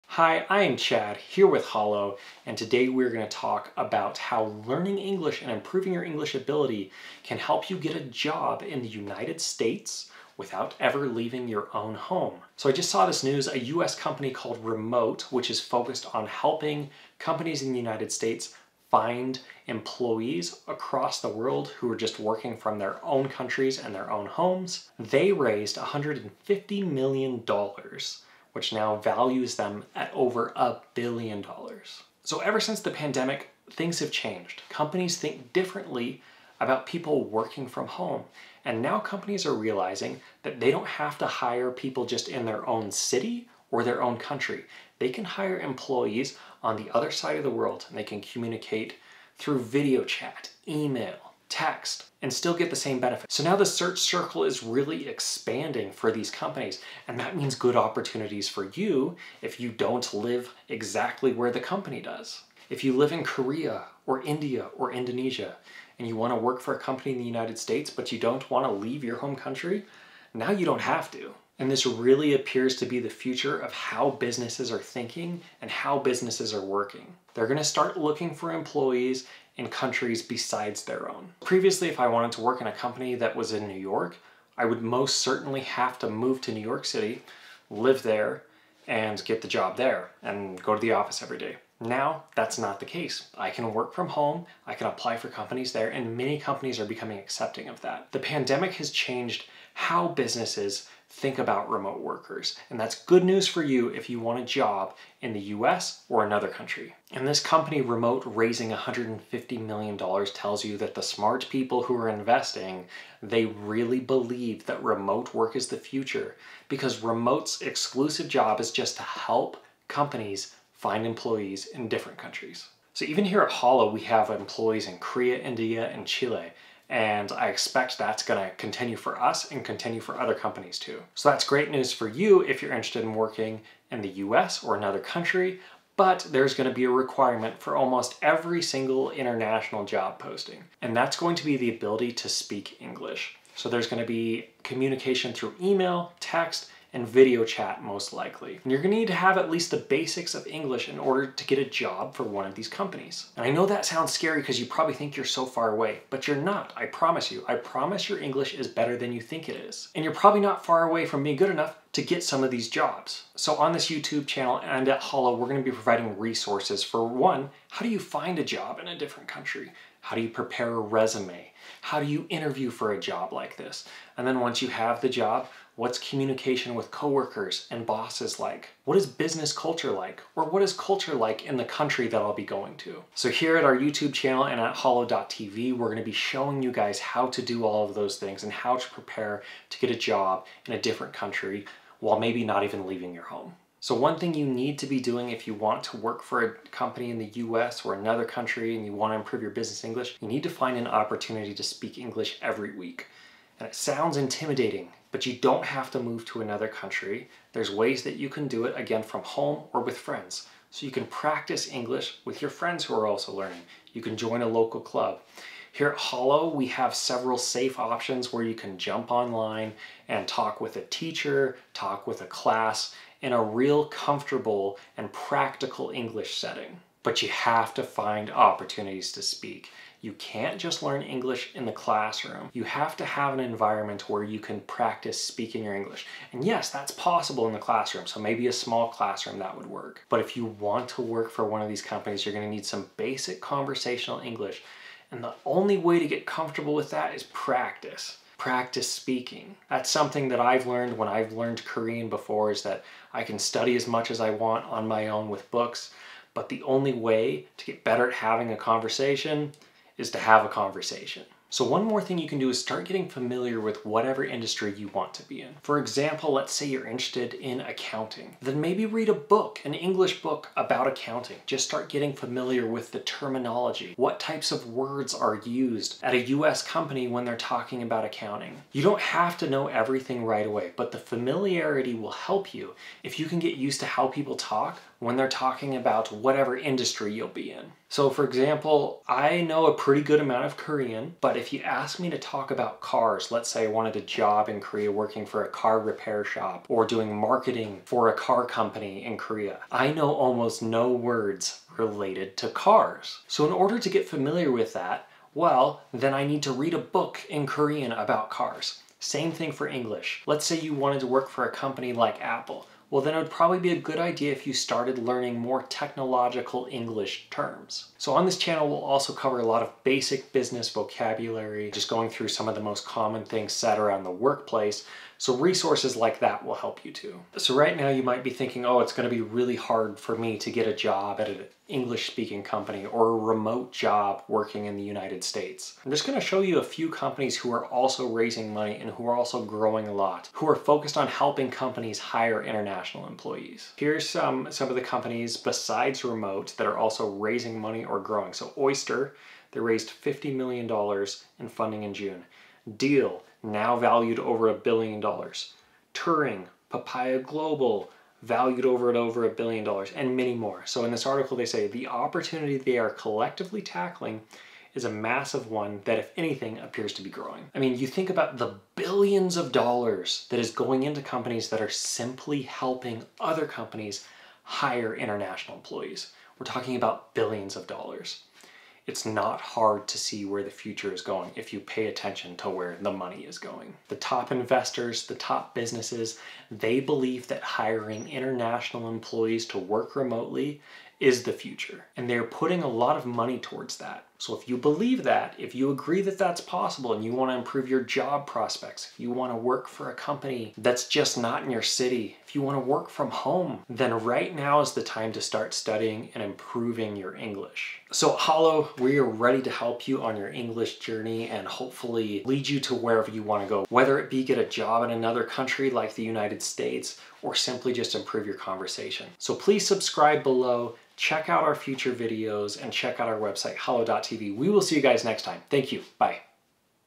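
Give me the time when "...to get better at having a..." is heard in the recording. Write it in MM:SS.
04:17.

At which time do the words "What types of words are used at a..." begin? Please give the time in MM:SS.
04:33.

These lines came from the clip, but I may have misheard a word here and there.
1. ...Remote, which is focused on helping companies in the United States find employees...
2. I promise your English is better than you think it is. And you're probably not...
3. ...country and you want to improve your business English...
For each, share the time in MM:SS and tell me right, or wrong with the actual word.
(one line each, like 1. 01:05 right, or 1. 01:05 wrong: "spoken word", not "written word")
1. 00:14 right
2. 02:37 right
3. 03:18 right.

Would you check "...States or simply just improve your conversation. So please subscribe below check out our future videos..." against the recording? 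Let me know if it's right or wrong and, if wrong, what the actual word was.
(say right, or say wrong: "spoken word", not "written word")
right.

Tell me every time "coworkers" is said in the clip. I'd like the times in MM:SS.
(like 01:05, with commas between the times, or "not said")
02:56.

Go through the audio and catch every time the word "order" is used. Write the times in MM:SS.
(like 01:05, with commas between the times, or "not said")
02:30, 05:03.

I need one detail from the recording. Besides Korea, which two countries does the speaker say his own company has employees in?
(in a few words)
India and Chile.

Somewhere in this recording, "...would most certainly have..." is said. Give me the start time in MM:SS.
01:24.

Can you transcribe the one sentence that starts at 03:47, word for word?
But you have to find opportunities to speak.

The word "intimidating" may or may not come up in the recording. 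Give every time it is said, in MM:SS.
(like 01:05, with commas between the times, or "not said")
03:24.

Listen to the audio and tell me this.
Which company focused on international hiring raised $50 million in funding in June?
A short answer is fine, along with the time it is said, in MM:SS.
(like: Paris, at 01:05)
Oyster, at 05:48.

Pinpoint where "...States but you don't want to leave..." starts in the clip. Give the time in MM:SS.
01:07.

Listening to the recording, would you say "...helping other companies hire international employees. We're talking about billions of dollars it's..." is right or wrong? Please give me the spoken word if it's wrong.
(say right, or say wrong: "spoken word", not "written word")
right.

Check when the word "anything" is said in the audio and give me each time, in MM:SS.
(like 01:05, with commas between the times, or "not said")
06:06.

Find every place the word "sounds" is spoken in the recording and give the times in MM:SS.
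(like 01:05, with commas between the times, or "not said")
02:33, 03:23.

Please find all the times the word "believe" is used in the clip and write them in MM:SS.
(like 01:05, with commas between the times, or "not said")
01:53, 06:26, 06:34.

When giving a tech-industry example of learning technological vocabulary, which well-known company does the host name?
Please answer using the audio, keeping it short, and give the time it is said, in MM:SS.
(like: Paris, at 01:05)
Apple, at 05:12.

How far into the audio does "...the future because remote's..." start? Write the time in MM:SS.
01:55.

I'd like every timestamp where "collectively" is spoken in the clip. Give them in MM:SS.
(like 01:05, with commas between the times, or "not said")
06:02.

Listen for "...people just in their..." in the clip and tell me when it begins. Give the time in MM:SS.
00:41.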